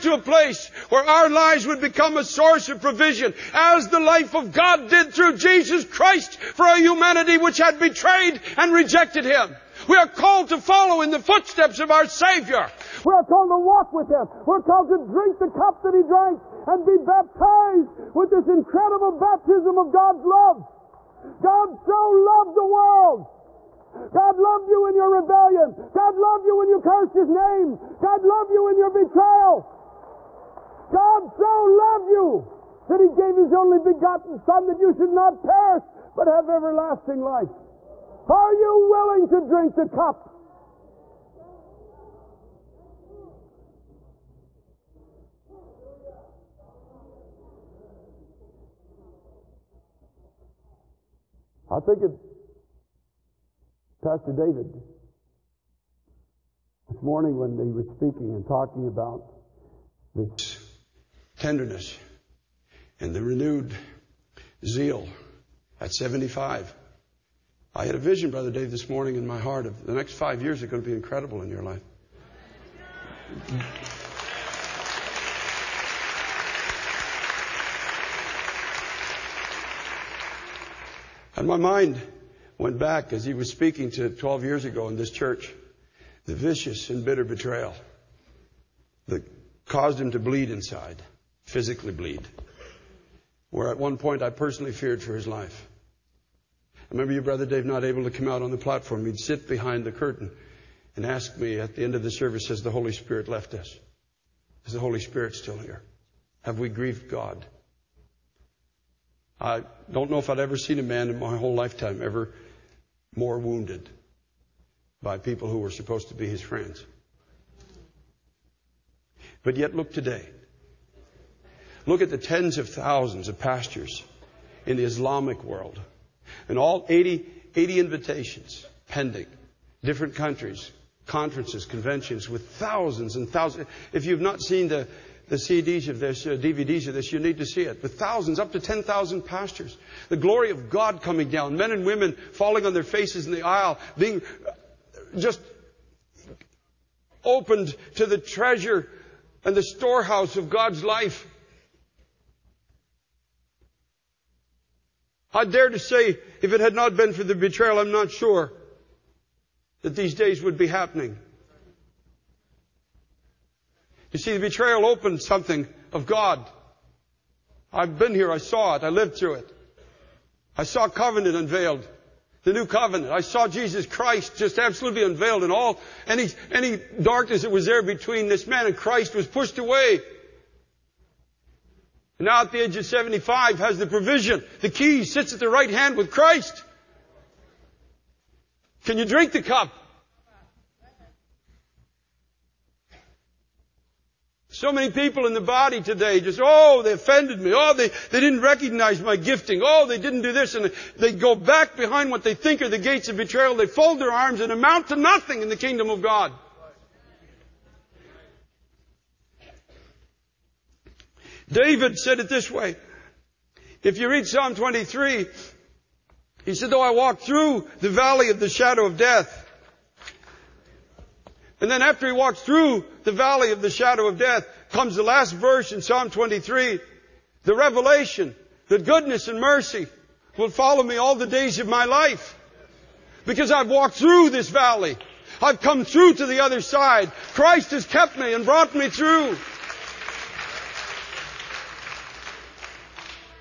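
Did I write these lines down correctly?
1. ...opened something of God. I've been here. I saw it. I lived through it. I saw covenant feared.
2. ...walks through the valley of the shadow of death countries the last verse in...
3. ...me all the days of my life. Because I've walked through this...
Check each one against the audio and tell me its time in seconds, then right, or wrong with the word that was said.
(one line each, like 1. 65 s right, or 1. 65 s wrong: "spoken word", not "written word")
1. 164 s wrong: "unveiled", not "feared"
2. 222 s wrong: "comes", not "countries"
3. 230 s right.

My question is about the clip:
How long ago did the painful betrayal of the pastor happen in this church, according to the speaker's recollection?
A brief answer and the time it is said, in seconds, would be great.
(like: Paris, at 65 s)
12 years ago, at 84 s.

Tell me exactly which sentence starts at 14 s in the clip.
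We're called to drink the cup that He drank and be baptized with this incredible baptism of God's love.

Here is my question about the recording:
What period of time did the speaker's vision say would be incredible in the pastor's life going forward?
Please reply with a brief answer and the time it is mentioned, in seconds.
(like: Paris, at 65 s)
Next 5 years, at 69 s.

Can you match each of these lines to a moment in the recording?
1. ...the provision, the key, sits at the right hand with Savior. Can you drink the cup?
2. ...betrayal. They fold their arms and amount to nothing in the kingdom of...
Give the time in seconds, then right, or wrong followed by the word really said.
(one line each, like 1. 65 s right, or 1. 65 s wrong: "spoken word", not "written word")
1. 183 s wrong: "Christ", not "Savior"
2. 203 s right.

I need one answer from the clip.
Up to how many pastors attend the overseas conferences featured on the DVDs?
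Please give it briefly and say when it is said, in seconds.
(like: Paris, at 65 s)
10,000, at 138 s.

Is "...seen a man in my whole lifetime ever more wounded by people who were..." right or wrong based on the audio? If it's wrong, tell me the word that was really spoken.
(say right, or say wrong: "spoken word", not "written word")
right.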